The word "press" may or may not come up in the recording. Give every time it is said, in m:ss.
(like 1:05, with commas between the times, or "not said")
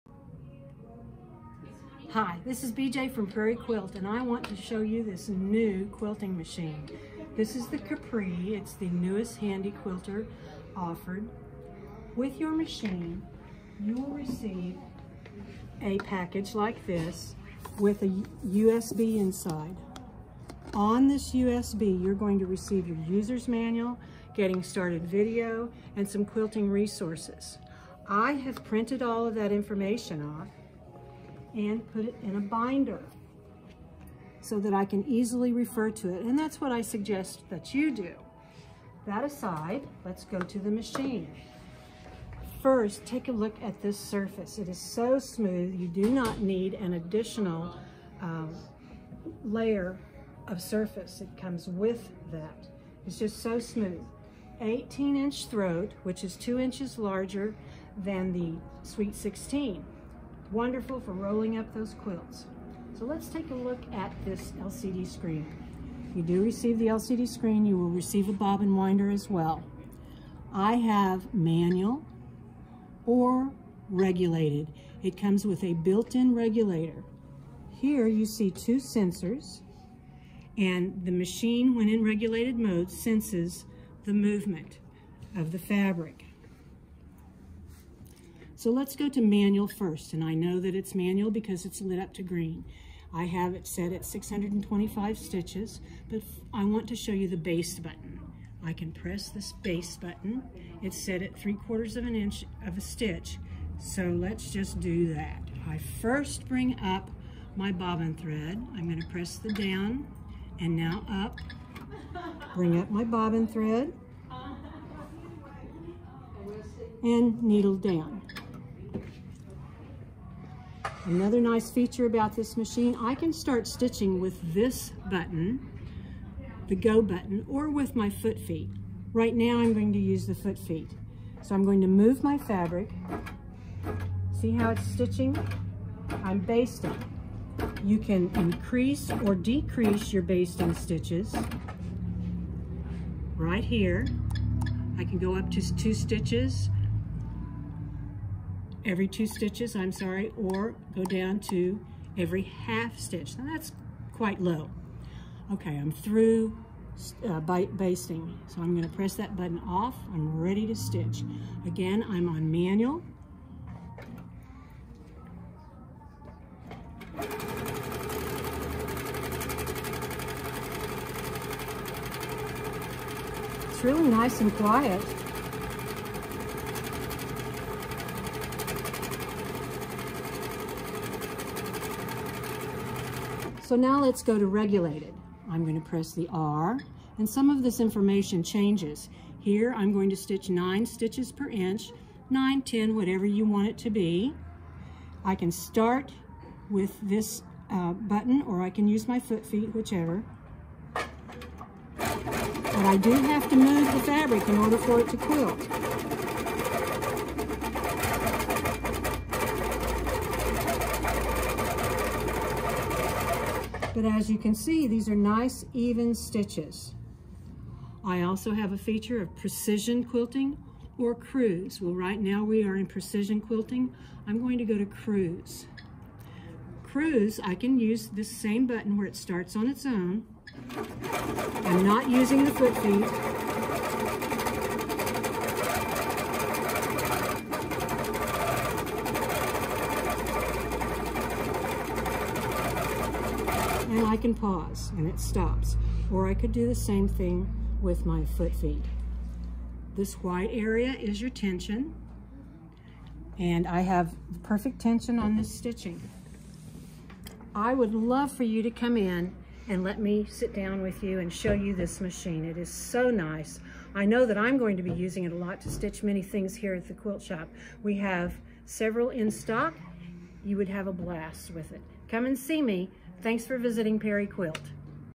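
1:38, 1:49, 2:38, 3:05.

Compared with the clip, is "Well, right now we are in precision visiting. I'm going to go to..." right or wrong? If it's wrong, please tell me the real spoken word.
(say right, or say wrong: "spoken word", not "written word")
wrong: "quilting", not "visiting".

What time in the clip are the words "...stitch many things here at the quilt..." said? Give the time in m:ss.
4:25.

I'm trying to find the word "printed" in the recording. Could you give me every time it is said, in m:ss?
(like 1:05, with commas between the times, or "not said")
0:28.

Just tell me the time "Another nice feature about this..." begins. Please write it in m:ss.
2:01.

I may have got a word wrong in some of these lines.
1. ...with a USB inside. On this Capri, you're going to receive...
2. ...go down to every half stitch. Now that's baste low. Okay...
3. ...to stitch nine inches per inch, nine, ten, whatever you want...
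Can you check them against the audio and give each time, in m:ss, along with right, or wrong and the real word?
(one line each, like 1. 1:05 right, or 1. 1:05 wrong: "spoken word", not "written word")
1. 0:17 wrong: "USB", not "Capri"
2. 2:30 wrong: "quite", not "baste"
3. 3:10 wrong: "stitches", not "inches".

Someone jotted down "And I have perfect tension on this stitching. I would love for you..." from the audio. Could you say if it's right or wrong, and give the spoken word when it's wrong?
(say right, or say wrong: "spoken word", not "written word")
right.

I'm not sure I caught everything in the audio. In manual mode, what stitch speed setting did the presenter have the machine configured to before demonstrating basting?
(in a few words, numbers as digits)
625 stitches.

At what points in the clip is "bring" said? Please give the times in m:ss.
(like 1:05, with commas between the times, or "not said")
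1:46, 1:52.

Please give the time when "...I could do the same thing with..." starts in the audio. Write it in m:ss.
4:06.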